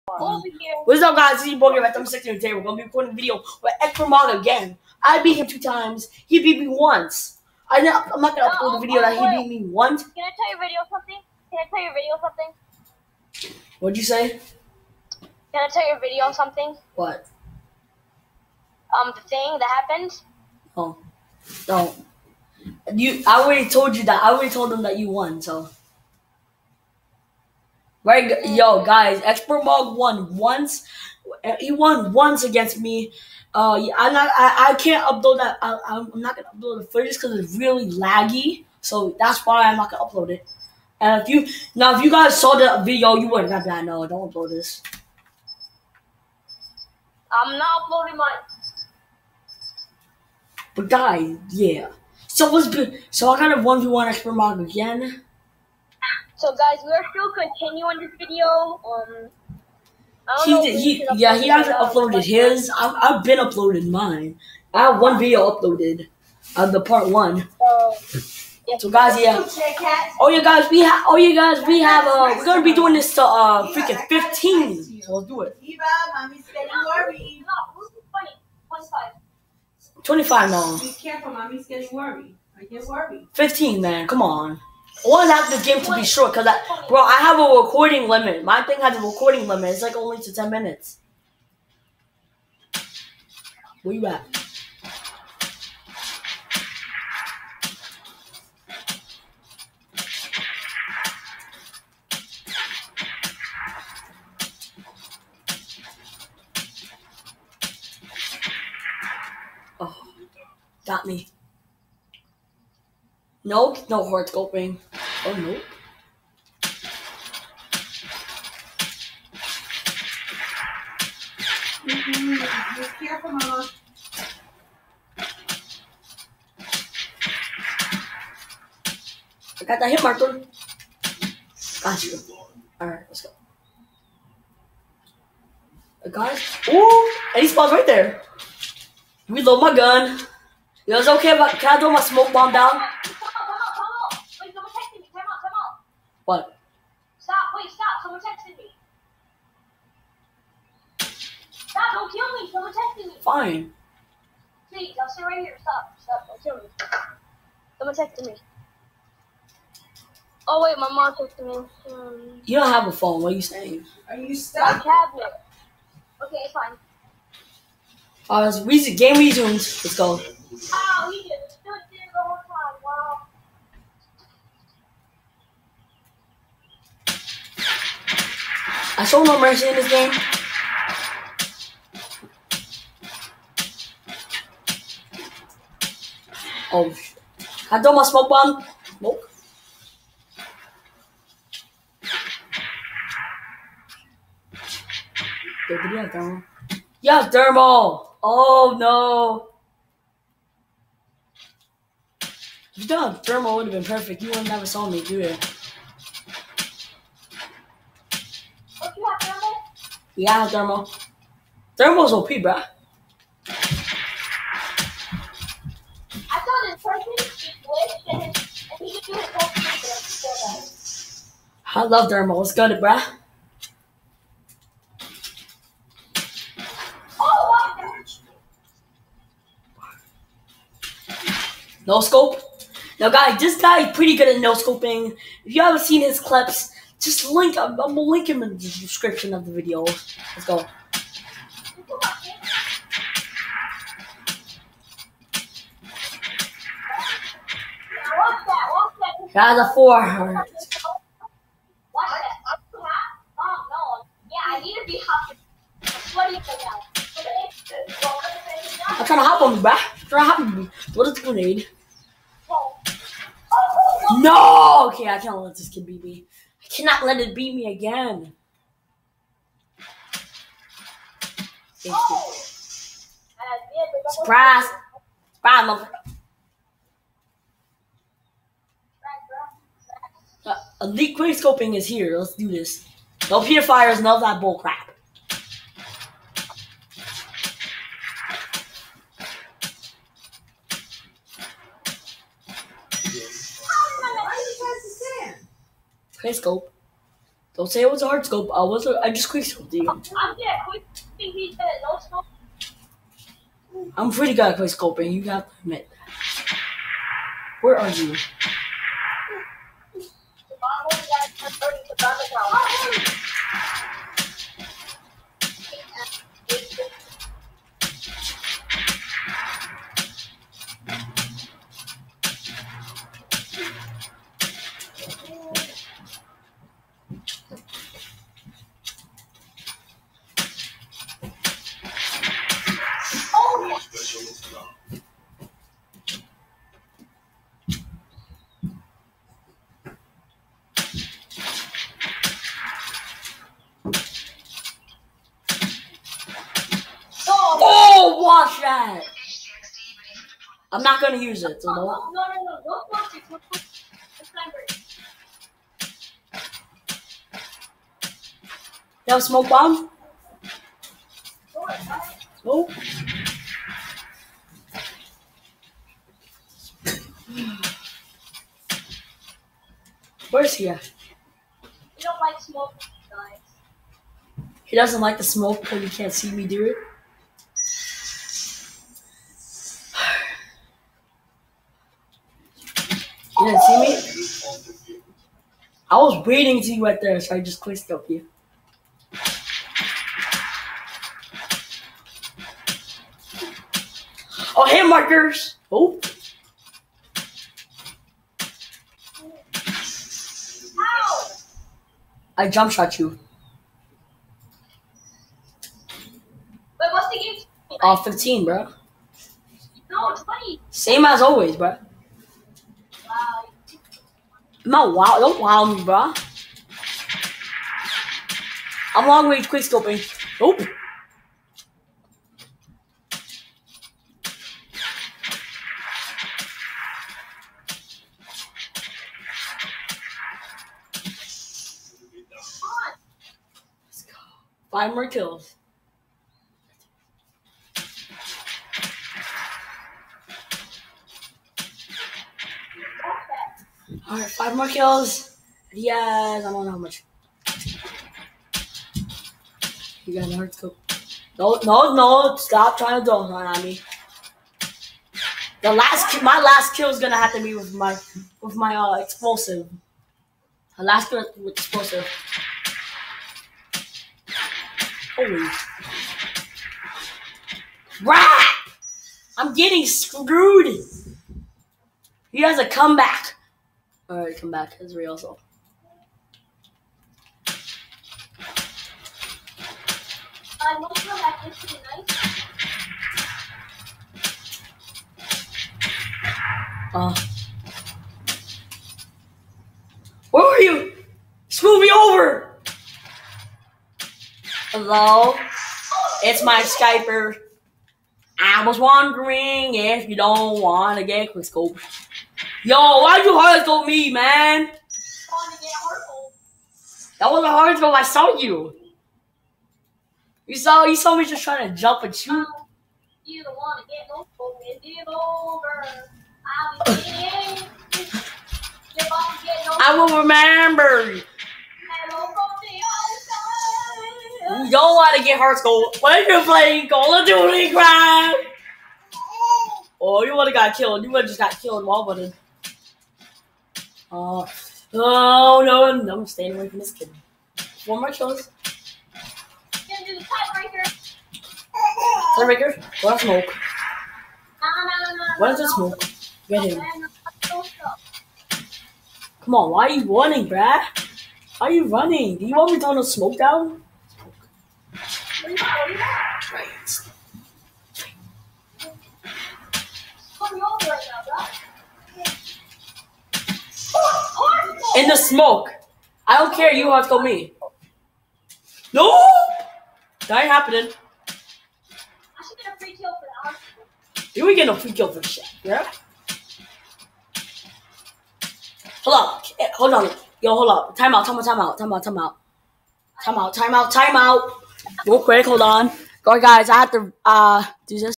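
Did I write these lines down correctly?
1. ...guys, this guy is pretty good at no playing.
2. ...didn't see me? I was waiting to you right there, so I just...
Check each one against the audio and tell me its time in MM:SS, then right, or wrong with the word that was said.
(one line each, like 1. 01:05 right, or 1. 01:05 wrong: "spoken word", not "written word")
1. 03:53 wrong: "scoping", not "playing"
2. 06:23 right.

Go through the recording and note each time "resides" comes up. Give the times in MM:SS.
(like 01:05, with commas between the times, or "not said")
not said.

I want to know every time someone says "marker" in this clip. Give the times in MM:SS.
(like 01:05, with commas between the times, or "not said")
02:10, 06:34.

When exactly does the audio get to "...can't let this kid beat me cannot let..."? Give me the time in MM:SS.
04:25.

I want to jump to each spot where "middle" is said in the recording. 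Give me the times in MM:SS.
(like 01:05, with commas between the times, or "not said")
not said.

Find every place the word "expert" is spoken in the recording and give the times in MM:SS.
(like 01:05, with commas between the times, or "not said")
00:29, 00:54.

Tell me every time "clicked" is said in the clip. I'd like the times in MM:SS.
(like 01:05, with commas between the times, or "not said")
06:27.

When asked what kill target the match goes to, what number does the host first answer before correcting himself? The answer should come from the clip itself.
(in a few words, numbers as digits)
15.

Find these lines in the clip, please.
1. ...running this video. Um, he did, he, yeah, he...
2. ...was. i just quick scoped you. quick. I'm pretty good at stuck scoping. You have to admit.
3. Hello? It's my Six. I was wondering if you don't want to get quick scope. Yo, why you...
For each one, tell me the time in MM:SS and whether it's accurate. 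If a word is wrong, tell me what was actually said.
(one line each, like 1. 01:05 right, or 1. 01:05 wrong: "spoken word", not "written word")
1. 00:57 wrong: "continuing", not "running"
2. 04:58 wrong: "quick", not "stuck"
3. 08:14 wrong: "Skyper", not "Six".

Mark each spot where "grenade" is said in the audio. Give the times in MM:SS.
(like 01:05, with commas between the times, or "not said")
04:21.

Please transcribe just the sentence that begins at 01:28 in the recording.
My thing has a recording limit.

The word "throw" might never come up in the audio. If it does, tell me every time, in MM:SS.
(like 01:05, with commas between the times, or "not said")
02:21, 03:07, 09:12.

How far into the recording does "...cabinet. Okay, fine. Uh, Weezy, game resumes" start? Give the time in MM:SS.
02:44.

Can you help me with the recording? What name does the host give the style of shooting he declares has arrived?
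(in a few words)
Elite quick scoping.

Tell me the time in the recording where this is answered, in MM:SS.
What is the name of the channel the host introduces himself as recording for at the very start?
00:01.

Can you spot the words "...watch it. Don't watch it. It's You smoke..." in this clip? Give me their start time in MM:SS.
05:52.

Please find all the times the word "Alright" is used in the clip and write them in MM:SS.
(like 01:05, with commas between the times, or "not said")
02:12, 07:24, 07:54.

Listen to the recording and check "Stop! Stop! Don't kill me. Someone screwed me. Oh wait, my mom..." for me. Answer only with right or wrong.
wrong.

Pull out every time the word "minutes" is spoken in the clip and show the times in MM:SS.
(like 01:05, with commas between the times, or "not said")
01:30.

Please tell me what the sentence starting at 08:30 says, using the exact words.
You saw you saw me just trying to jump and shoot.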